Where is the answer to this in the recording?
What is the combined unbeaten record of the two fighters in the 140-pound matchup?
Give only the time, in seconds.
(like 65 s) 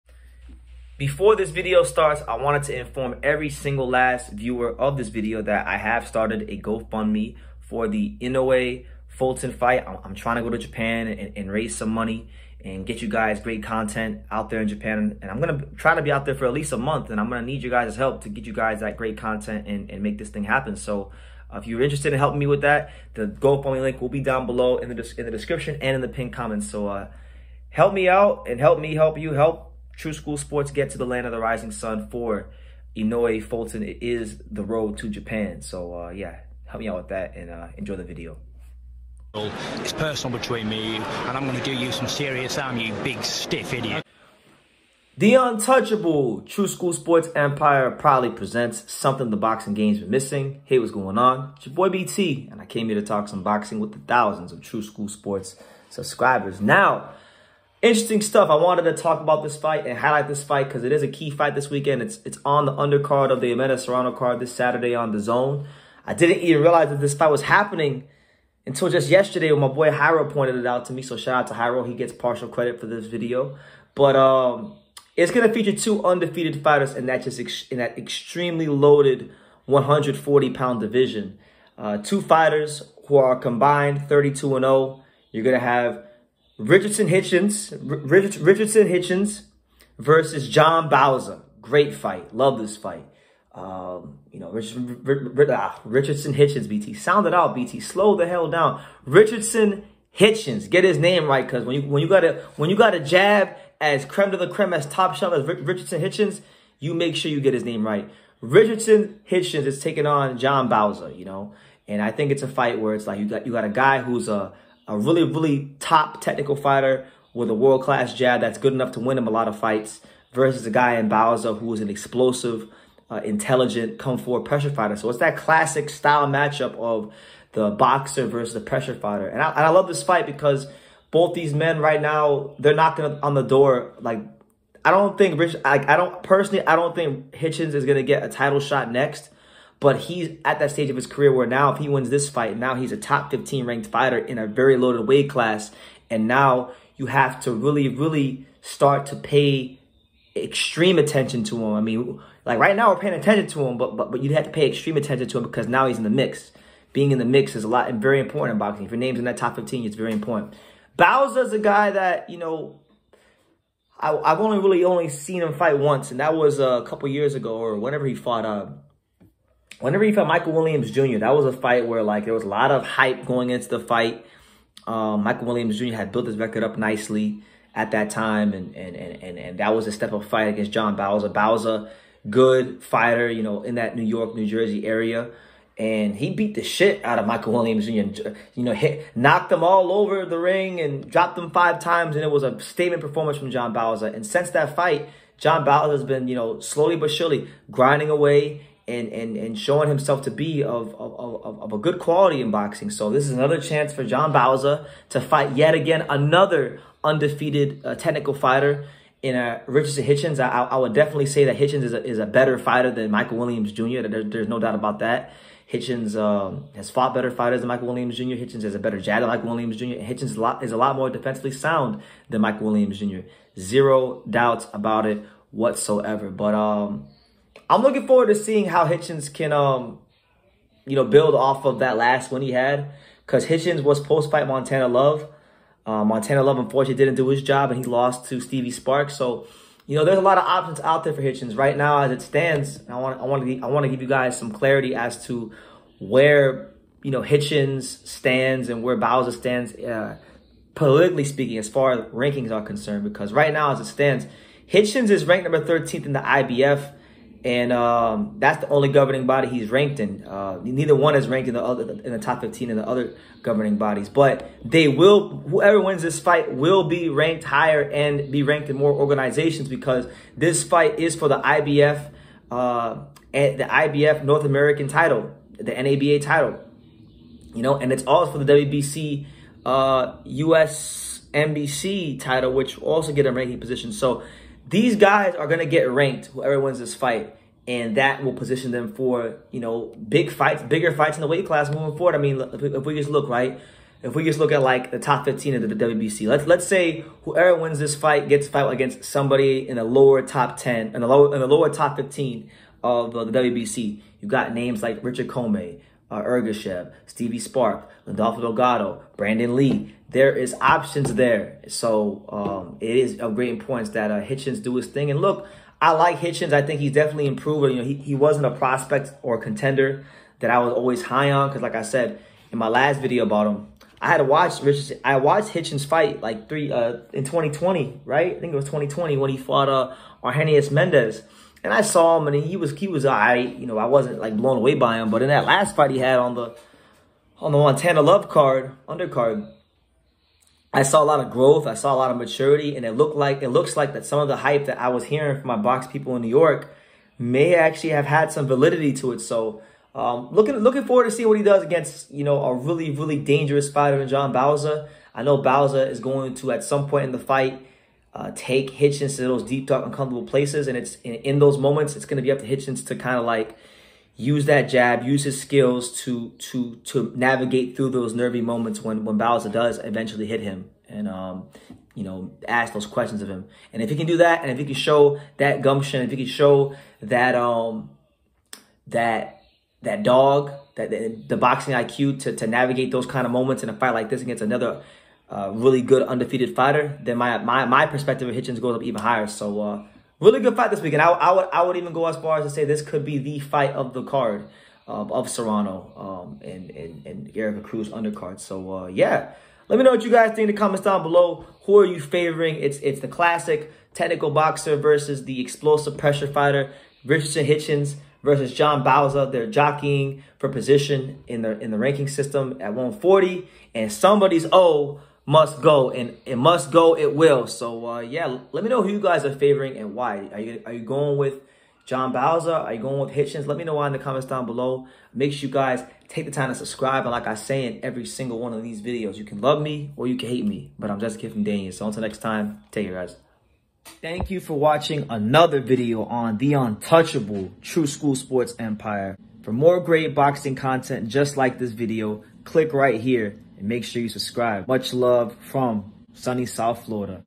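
84 s.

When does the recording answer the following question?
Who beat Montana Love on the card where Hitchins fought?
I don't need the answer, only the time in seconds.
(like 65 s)
238 s.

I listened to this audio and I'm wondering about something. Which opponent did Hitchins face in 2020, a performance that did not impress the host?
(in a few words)
Argenis Mendez.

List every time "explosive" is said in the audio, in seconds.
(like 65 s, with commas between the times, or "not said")
121 s, 405 s.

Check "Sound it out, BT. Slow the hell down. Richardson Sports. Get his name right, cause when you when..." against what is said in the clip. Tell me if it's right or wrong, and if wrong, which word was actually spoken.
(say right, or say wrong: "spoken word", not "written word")
wrong: "Hitchins", not "Sports".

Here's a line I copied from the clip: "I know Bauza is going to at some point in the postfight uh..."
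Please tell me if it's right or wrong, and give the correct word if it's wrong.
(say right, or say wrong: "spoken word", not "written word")
wrong: "fight", not "postfight".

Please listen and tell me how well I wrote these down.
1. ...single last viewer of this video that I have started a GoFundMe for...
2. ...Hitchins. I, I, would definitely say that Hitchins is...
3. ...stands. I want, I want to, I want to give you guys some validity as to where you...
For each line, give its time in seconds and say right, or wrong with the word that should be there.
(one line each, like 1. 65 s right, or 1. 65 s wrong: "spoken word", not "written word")
1. 3 s right
2. 210 s right
3. 242 s wrong: "clarity", not "validity".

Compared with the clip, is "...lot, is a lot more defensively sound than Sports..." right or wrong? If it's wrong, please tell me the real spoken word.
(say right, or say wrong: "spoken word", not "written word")
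wrong: "Michael", not "Sports".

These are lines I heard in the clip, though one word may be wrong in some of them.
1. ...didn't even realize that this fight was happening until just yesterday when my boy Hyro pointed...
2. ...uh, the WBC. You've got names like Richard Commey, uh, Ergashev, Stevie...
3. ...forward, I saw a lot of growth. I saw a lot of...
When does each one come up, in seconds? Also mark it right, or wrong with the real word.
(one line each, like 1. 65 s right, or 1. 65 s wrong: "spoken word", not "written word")
1. 66 s right
2. 303 s right
3. 338 s wrong: "undercard", not "forward".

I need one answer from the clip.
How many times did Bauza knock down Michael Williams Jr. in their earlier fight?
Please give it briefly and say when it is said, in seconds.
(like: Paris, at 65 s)
5, at 191 s.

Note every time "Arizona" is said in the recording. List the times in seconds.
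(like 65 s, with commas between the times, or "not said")
not said.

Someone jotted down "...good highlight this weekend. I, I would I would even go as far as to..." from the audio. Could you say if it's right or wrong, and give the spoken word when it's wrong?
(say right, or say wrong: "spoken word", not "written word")
wrong: "fight", not "highlight".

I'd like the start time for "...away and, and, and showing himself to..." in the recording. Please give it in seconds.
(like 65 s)
198 s.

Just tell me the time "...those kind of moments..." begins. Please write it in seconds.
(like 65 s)
382 s.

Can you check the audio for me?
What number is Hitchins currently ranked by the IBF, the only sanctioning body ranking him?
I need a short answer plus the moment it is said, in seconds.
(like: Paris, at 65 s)
13, at 255 s.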